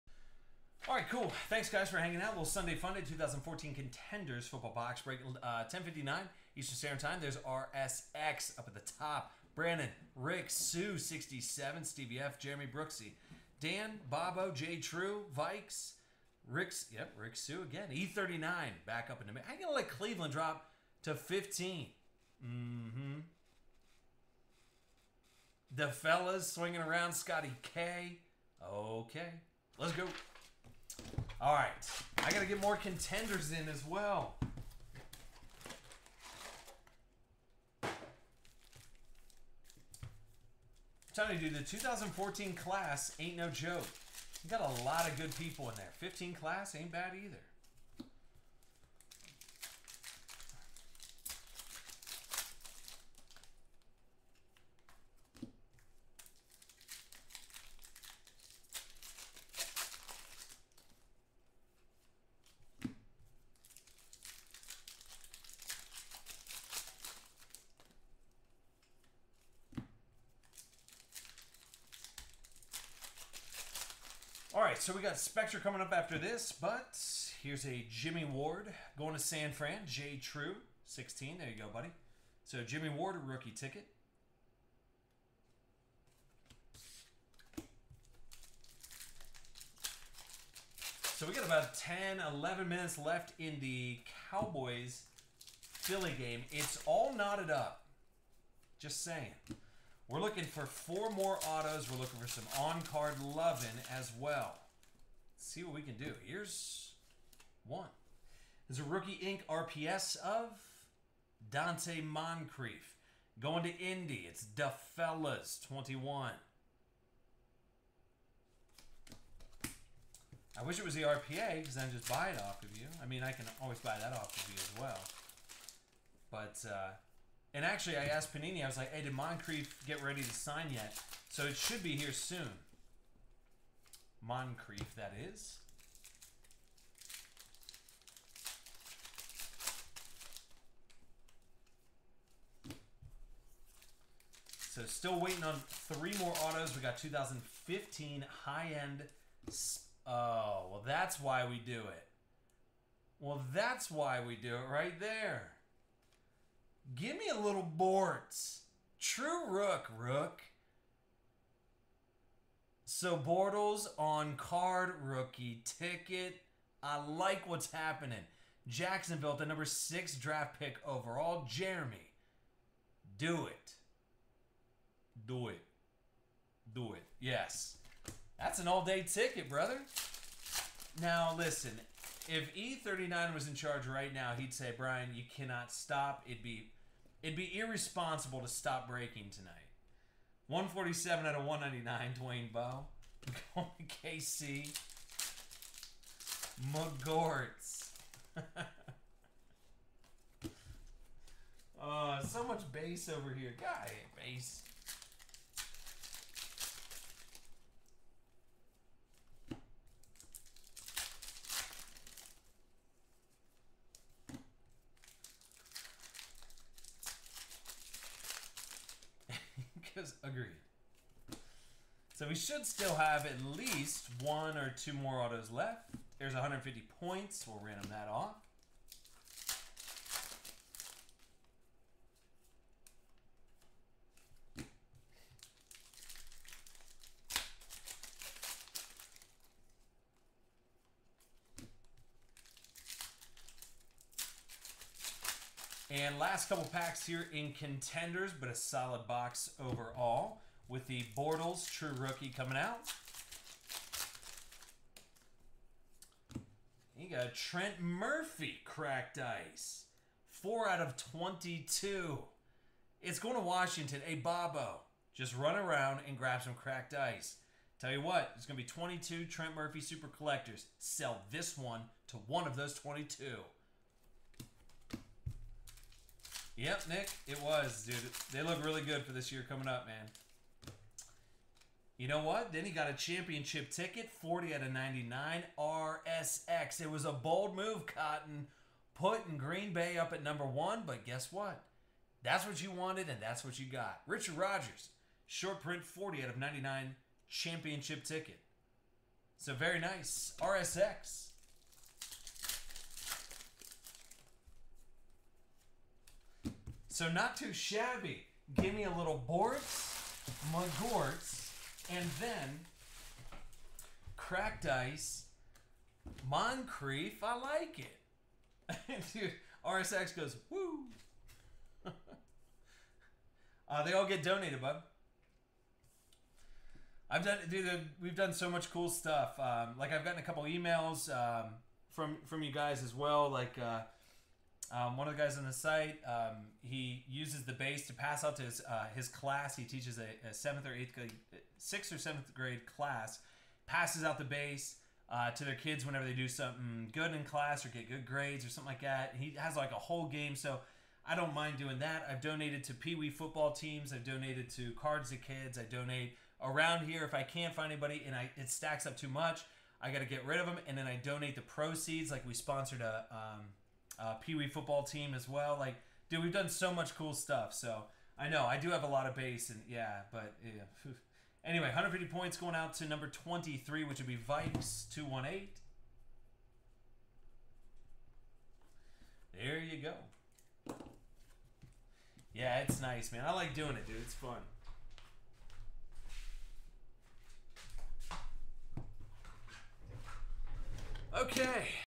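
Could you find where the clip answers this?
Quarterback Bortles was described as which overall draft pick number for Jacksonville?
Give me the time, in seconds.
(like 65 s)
169 s.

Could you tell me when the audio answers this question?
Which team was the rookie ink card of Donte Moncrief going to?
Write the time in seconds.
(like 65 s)
113 s.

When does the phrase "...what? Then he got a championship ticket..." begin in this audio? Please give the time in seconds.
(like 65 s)
282 s.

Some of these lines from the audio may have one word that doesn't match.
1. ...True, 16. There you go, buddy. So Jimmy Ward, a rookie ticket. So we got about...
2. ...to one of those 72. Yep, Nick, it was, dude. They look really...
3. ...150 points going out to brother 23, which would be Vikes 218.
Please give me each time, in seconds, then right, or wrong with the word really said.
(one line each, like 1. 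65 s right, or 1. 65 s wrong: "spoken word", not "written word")
1. 80 s right
2. 272 s wrong: "22", not "72"
3. 371 s wrong: "number", not "brother".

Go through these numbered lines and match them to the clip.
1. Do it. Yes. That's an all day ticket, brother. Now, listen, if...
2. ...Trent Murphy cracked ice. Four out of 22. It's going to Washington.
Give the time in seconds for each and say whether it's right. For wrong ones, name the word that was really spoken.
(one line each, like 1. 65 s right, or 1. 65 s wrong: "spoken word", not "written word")
1. 176 s right
2. 257 s right.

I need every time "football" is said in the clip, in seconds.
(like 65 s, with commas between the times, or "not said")
4 s, 353 s, 364 s.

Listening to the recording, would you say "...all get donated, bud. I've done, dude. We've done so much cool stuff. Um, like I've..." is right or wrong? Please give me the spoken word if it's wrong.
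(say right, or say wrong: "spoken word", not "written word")
right.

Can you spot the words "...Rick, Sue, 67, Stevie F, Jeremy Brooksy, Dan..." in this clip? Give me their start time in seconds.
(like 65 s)
10 s.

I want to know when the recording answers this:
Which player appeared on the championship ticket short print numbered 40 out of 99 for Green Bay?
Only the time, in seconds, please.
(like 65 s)
294 s.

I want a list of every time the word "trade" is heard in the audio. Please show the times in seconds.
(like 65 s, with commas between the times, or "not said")
not said.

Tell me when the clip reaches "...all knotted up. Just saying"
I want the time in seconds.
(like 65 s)
96 s.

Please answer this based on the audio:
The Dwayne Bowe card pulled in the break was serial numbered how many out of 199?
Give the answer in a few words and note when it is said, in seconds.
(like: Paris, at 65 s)
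147, at 190 s.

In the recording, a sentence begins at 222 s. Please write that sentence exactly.
So we should still have at least one or two more autos left.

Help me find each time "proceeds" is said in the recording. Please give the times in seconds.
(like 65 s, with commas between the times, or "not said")
361 s.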